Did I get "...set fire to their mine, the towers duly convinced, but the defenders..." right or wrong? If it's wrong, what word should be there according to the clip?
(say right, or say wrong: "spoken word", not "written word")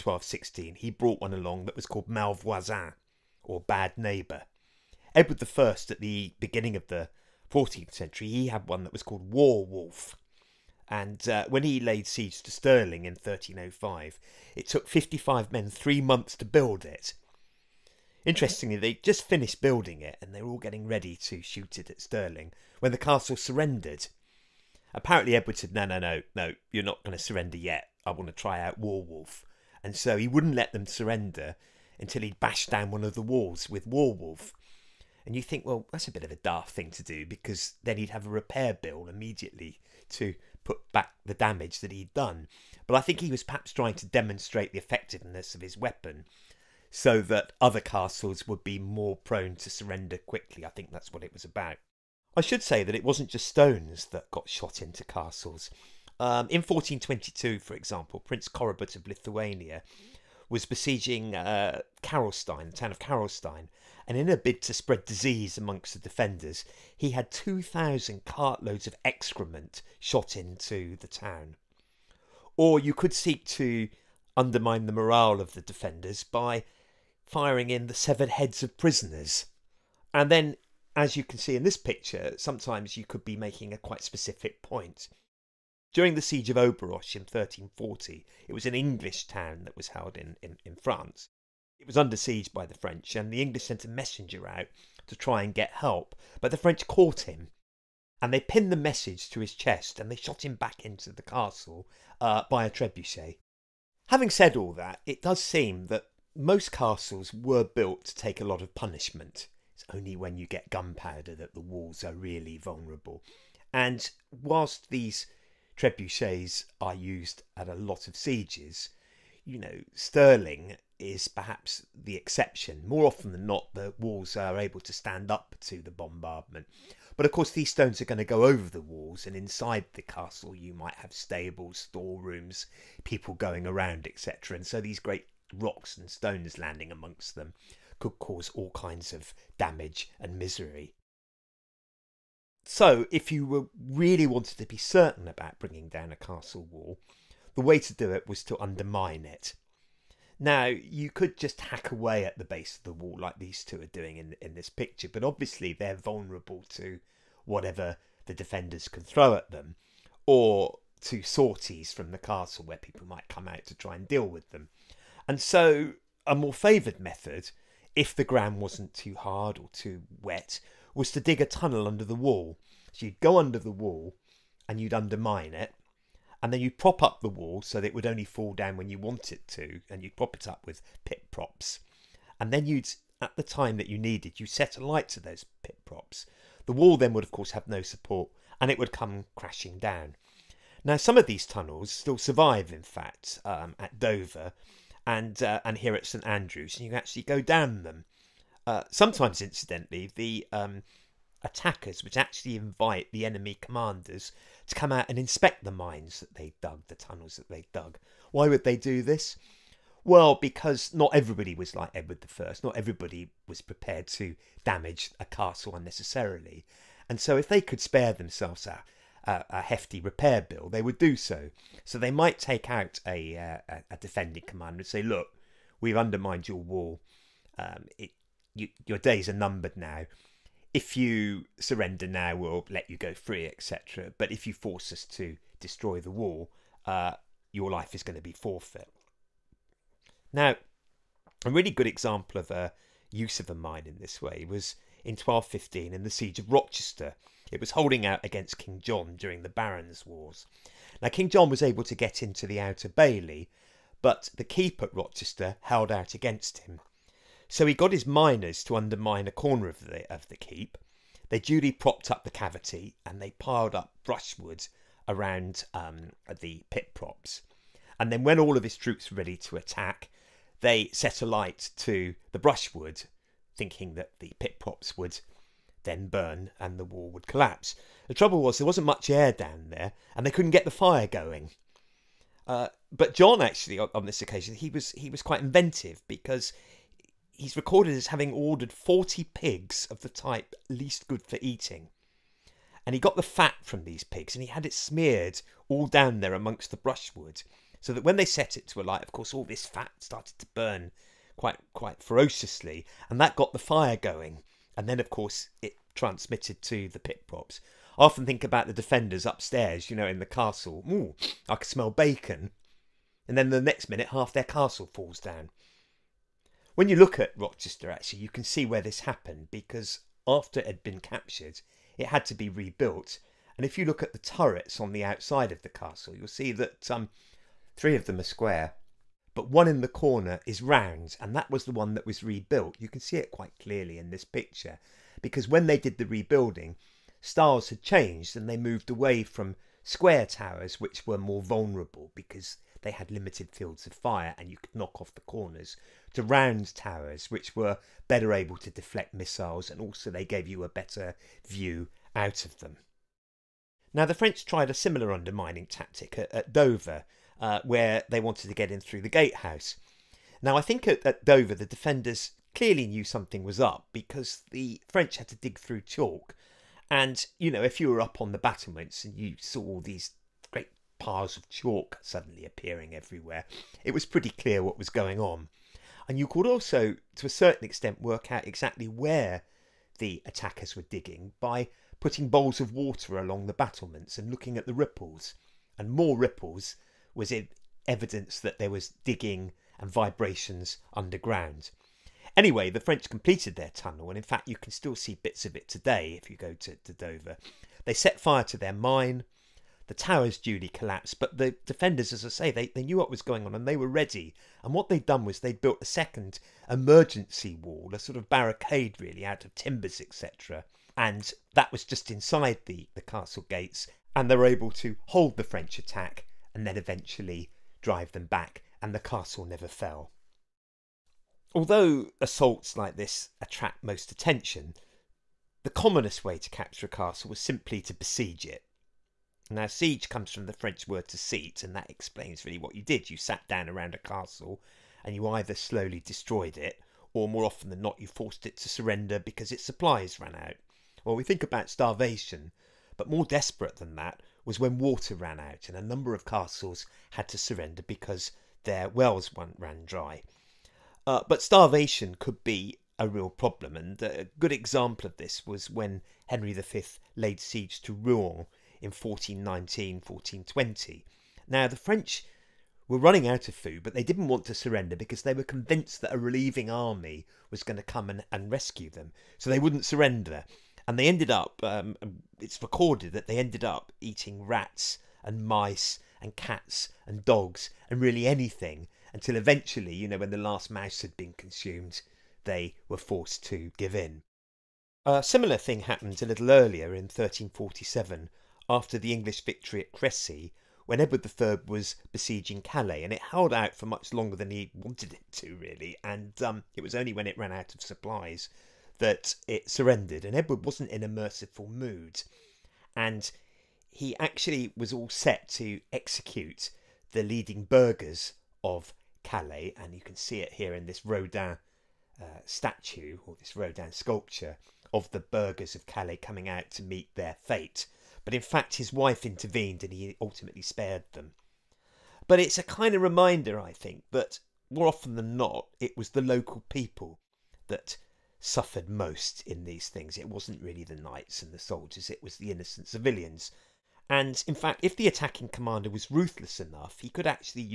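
wrong: "collapsed", not "convinced".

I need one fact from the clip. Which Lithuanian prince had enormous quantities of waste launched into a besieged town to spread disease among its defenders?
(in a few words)
Prince Korybut.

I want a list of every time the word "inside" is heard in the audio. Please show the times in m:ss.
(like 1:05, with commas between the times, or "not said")
2:09, 6:52.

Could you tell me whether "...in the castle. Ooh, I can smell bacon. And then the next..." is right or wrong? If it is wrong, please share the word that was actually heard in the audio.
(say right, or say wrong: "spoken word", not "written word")
right.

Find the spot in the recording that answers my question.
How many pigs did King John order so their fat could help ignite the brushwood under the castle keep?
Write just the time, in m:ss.
4:48.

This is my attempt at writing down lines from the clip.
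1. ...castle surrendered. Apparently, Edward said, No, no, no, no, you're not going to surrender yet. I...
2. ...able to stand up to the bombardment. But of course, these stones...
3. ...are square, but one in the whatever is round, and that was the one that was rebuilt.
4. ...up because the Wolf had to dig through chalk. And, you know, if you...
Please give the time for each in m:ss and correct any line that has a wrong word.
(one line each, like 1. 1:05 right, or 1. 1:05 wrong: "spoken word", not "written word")
1. 0:22 right
2. 2:04 right
3. 5:28 wrong: "corner", not "whatever"
4. 6:03 wrong: "French", not "Wolf".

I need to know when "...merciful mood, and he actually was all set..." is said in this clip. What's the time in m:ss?
8:21.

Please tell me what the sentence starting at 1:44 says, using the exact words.
Having said all that, it does seem that most castles were built to take a lot of punishment.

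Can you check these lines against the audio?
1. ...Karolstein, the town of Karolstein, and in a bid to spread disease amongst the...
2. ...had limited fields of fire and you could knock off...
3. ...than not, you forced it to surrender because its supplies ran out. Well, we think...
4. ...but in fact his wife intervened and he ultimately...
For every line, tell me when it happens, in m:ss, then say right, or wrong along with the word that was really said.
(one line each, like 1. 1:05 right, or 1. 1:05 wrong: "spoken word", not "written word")
1. 1:02 right
2. 5:42 right
3. 7:17 right
4. 8:38 right.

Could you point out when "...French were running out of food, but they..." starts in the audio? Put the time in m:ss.
7:41.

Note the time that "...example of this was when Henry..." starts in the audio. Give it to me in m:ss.
7:34.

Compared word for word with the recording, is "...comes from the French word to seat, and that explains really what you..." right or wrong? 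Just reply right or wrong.
right.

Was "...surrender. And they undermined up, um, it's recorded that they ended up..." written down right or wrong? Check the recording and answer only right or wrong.
wrong.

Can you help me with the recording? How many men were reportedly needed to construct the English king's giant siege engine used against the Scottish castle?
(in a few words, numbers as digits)
55.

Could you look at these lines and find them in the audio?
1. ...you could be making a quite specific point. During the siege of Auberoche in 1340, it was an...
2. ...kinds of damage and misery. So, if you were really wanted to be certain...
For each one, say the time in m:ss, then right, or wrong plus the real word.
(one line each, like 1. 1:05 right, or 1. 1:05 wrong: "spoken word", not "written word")
1. 1:22 right
2. 2:18 right.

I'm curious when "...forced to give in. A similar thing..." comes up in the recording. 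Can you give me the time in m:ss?
8:02.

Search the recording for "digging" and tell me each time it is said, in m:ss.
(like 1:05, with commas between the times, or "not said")
6:20, 6:29.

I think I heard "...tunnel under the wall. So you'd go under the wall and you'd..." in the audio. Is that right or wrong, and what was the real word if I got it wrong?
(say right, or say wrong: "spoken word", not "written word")
right.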